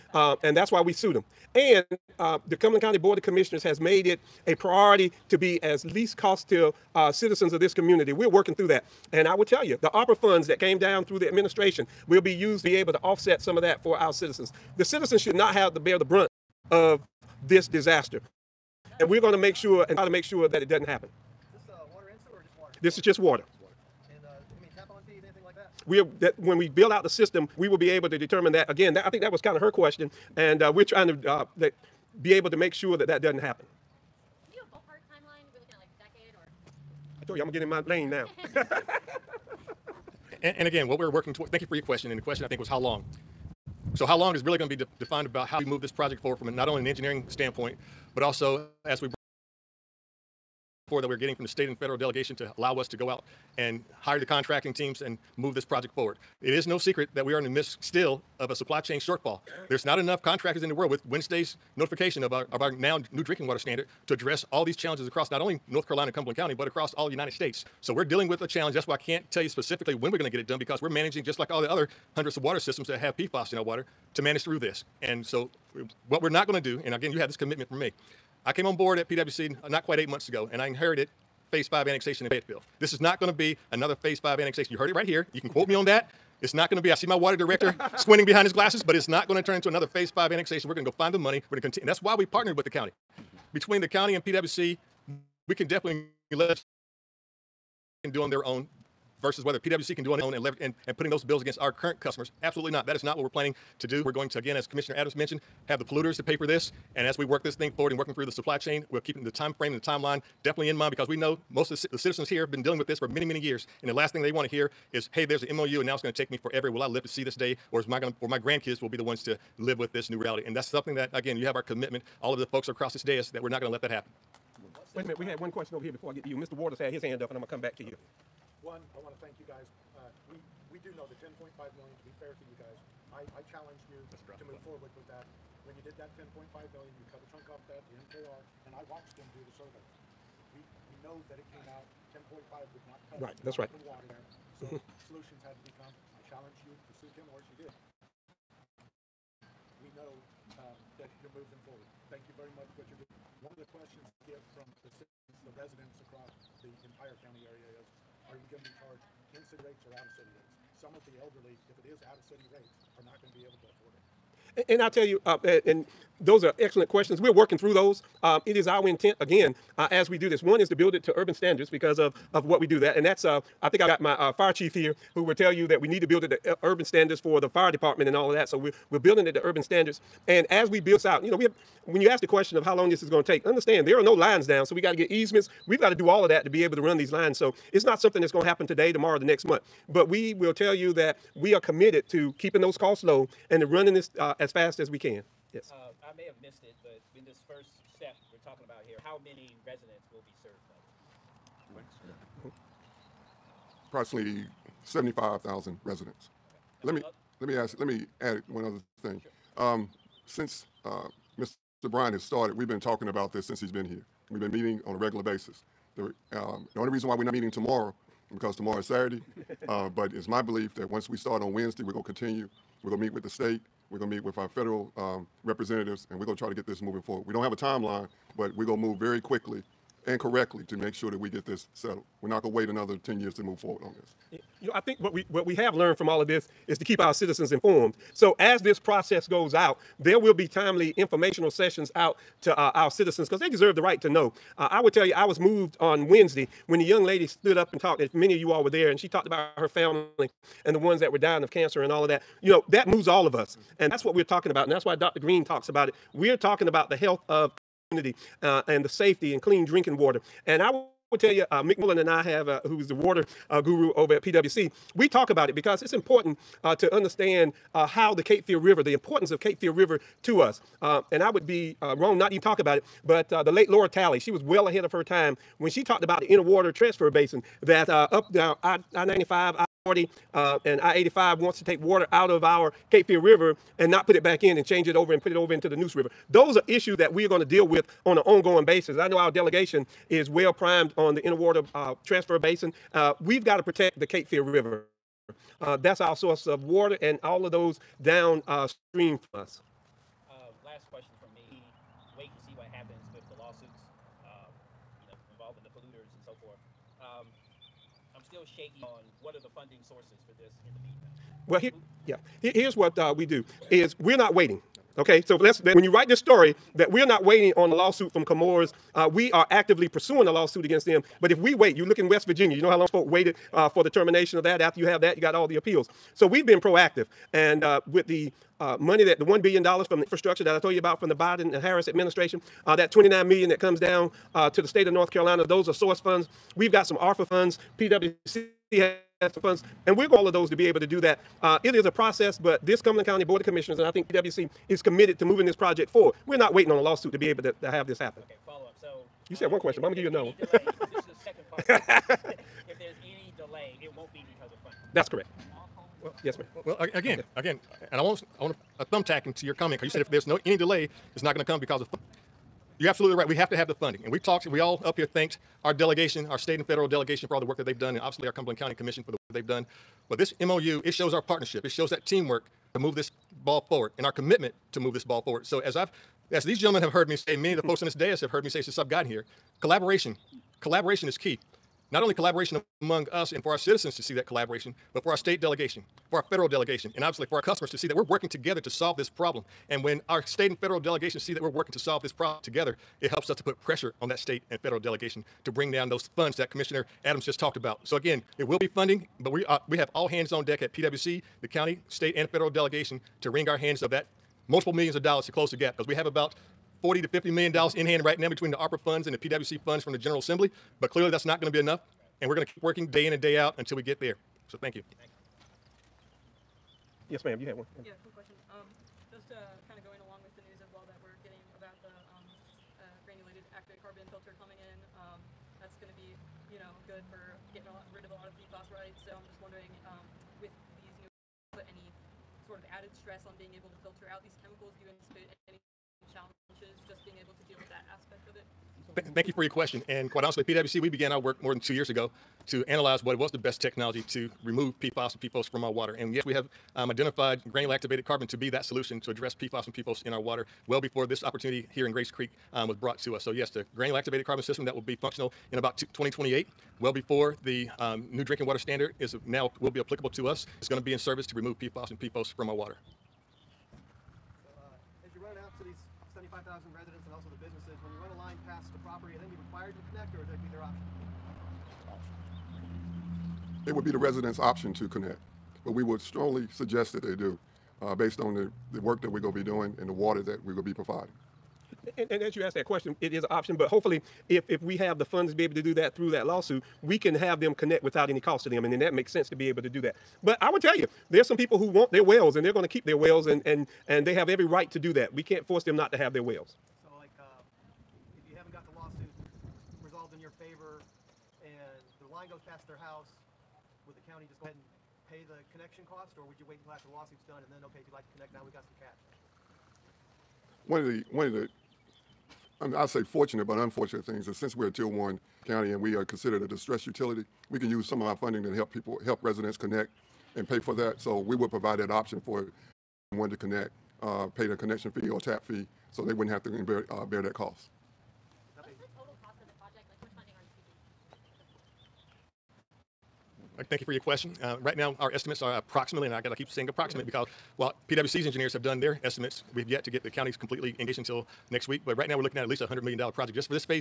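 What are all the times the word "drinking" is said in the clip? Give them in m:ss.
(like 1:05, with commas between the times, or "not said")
1:03, 4:19, 7:38.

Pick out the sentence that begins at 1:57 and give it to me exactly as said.
Or is my going to, or my grandkids will be the ones to live with this new reality?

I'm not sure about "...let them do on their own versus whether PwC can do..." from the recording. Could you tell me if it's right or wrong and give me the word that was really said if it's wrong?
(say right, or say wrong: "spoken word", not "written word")
right.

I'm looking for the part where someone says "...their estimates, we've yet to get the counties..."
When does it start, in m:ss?
8:58.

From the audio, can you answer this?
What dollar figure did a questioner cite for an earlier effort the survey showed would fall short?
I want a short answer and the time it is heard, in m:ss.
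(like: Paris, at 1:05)
$10.5 million, at 2:16.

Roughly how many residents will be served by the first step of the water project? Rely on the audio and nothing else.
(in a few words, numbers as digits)
75,000.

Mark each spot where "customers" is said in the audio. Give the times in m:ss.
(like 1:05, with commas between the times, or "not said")
1:42, 6:27.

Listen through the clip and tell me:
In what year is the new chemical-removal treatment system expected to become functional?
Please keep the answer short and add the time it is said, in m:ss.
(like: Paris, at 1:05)
2028, at 7:35.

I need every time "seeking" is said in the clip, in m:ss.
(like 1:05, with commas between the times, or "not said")
8:53.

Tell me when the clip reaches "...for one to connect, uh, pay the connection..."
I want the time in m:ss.
8:42.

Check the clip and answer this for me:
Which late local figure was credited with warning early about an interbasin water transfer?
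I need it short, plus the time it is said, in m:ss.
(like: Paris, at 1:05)
Lura Tally, at 4:33.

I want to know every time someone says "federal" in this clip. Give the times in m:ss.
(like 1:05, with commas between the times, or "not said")
0:51, 3:44, 6:06, 6:26, 6:30, 6:34, 6:42.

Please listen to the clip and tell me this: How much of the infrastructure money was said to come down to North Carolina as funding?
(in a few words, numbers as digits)
$29 million.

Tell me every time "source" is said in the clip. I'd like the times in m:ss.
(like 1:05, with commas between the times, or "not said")
4:56, 5:09, 5:35.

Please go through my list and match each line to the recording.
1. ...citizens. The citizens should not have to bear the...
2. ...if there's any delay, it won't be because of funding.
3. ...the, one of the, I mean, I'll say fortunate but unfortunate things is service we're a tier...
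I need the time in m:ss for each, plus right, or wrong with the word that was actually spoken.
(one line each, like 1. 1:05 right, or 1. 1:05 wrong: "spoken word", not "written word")
1. 0:14 right
2. 5:50 right
3. 8:30 wrong: "since", not "service".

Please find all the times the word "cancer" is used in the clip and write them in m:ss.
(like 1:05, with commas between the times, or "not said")
4:11.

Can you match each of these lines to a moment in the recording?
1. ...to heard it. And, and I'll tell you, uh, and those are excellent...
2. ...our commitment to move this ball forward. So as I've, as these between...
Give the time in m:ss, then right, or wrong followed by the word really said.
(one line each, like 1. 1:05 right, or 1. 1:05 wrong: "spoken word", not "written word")
1. 2:43 wrong: "afford", not "heard"
2. 6:14 wrong: "gentlemen", not "between".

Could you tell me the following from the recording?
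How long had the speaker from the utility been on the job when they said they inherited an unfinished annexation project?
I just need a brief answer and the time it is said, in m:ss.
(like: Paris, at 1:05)
not quite 8 months, at 1:19.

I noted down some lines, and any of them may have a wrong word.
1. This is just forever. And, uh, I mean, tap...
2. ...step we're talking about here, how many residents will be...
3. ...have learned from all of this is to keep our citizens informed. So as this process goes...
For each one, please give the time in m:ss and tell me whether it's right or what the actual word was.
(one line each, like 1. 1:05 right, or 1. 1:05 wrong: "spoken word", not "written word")
1. 0:22 wrong: "water", not "forever"
2. 3:17 right
3. 3:55 right.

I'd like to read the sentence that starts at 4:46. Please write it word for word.
Those are issues that we are going to deal with on an ongoing basis.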